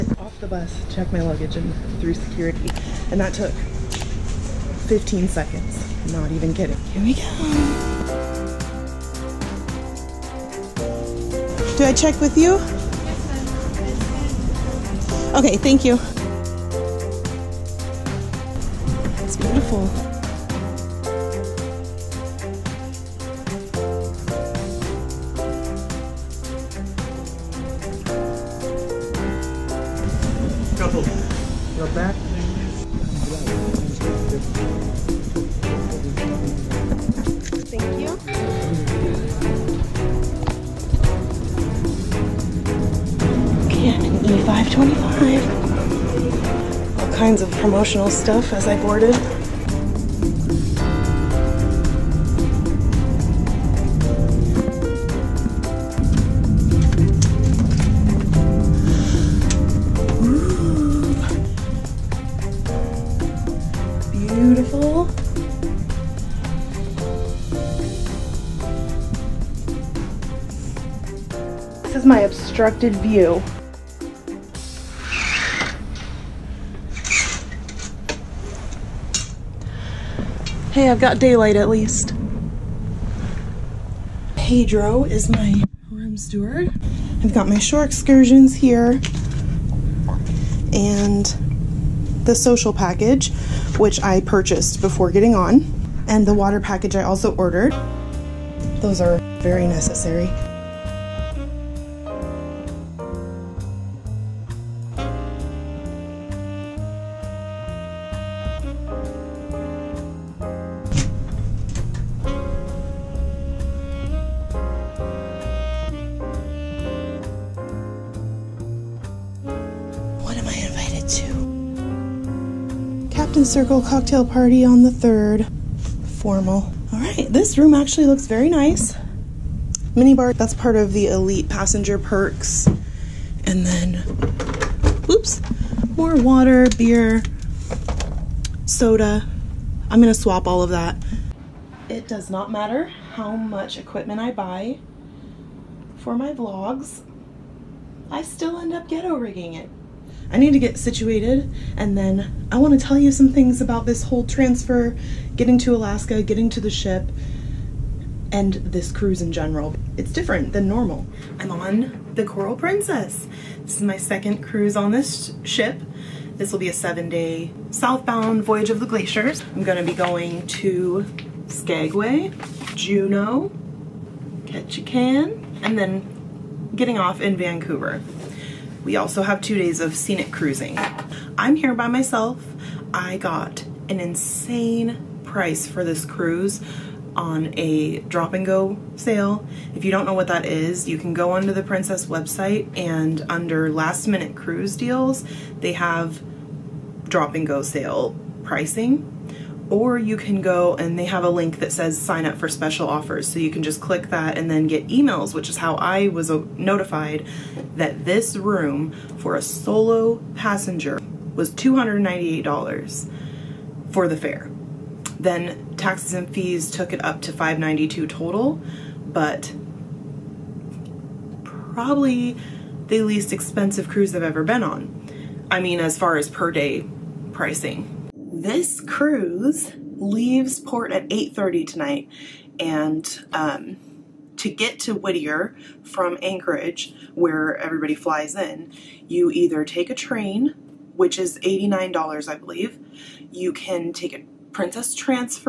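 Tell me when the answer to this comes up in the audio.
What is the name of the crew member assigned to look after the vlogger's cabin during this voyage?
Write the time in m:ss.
1:24.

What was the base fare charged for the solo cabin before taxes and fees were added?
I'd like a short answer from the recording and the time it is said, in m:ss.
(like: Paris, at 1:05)
$298, at 3:31.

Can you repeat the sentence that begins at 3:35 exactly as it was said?
Then taxes and fees took it up to 592 total, but probably the least expensive cruise I've ever been on.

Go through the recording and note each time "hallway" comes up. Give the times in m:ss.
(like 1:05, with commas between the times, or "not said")
not said.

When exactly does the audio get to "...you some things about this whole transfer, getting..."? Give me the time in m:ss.
2:32.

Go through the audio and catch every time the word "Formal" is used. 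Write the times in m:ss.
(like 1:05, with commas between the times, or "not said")
2:06.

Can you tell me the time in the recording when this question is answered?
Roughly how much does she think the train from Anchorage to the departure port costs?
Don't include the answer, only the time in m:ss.
4:01.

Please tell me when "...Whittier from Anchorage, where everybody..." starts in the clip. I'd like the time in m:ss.
3:54.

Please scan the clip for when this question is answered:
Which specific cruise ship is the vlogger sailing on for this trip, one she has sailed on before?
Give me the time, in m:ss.
2:42.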